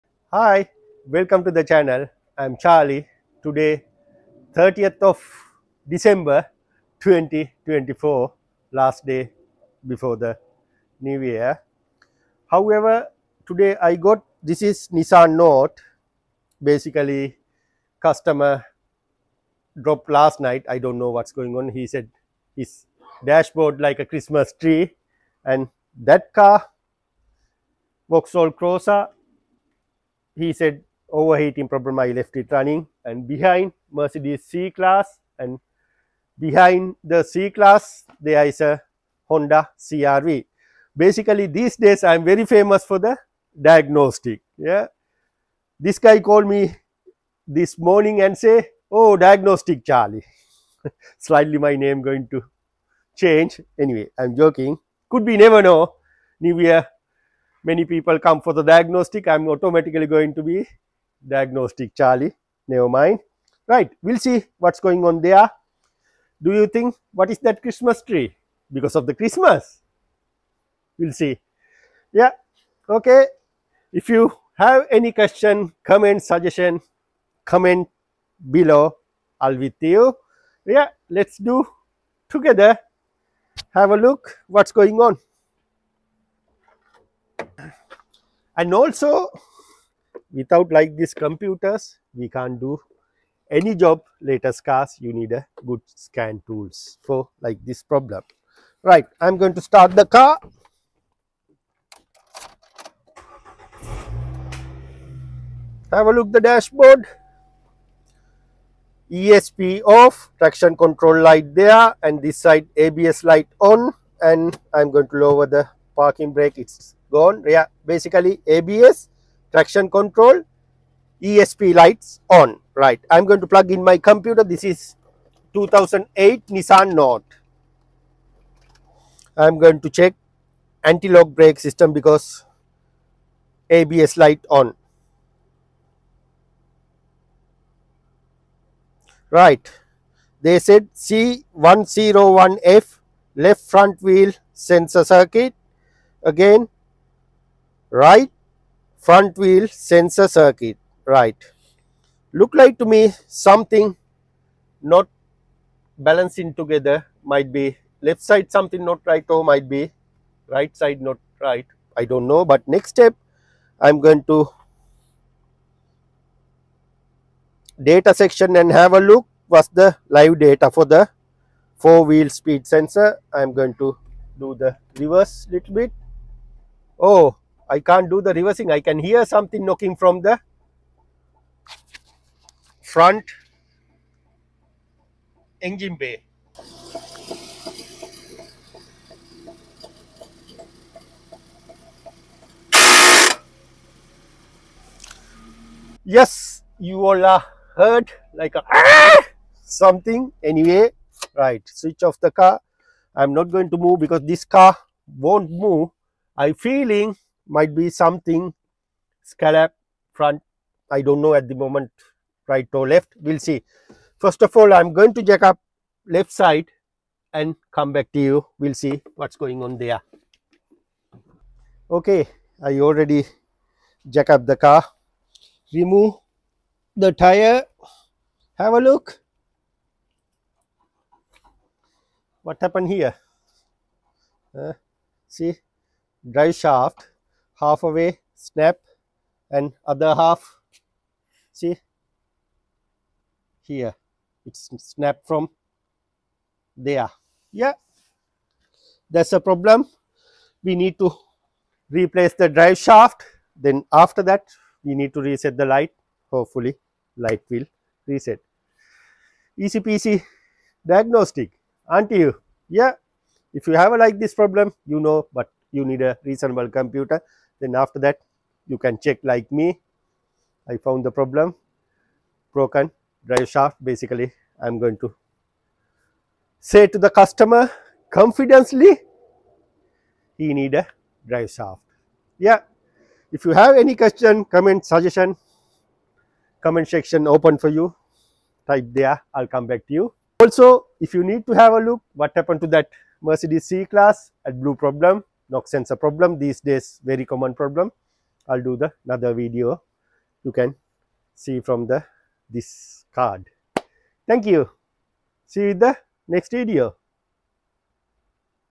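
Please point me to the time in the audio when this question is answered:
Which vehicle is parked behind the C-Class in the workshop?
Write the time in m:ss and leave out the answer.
0:39.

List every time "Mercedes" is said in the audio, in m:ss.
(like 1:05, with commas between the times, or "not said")
0:33, 4:53.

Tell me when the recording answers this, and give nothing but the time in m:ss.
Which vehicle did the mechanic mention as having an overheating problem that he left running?
0:28.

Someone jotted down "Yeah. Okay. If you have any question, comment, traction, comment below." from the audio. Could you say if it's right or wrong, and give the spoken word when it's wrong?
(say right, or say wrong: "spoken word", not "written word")
wrong: "suggestion", not "traction".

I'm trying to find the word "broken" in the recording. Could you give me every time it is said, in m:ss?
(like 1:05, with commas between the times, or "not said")
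4:32.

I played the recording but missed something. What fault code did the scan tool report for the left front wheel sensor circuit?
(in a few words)
C101F.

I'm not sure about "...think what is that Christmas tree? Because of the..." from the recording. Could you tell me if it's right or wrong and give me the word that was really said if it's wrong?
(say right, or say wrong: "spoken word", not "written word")
right.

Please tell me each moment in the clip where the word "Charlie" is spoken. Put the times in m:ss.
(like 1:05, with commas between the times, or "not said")
0:02, 0:49, 1:01.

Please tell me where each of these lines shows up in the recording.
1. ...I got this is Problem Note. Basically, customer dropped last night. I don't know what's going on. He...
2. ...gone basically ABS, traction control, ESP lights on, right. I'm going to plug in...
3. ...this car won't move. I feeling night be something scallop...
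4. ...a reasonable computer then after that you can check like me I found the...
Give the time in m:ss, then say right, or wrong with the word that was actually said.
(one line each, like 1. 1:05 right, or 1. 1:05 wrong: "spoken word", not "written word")
1. 0:13 wrong: "Nissan", not "Problem"
2. 1:57 right
3. 3:24 wrong: "might", not "night"
4. 4:26 right.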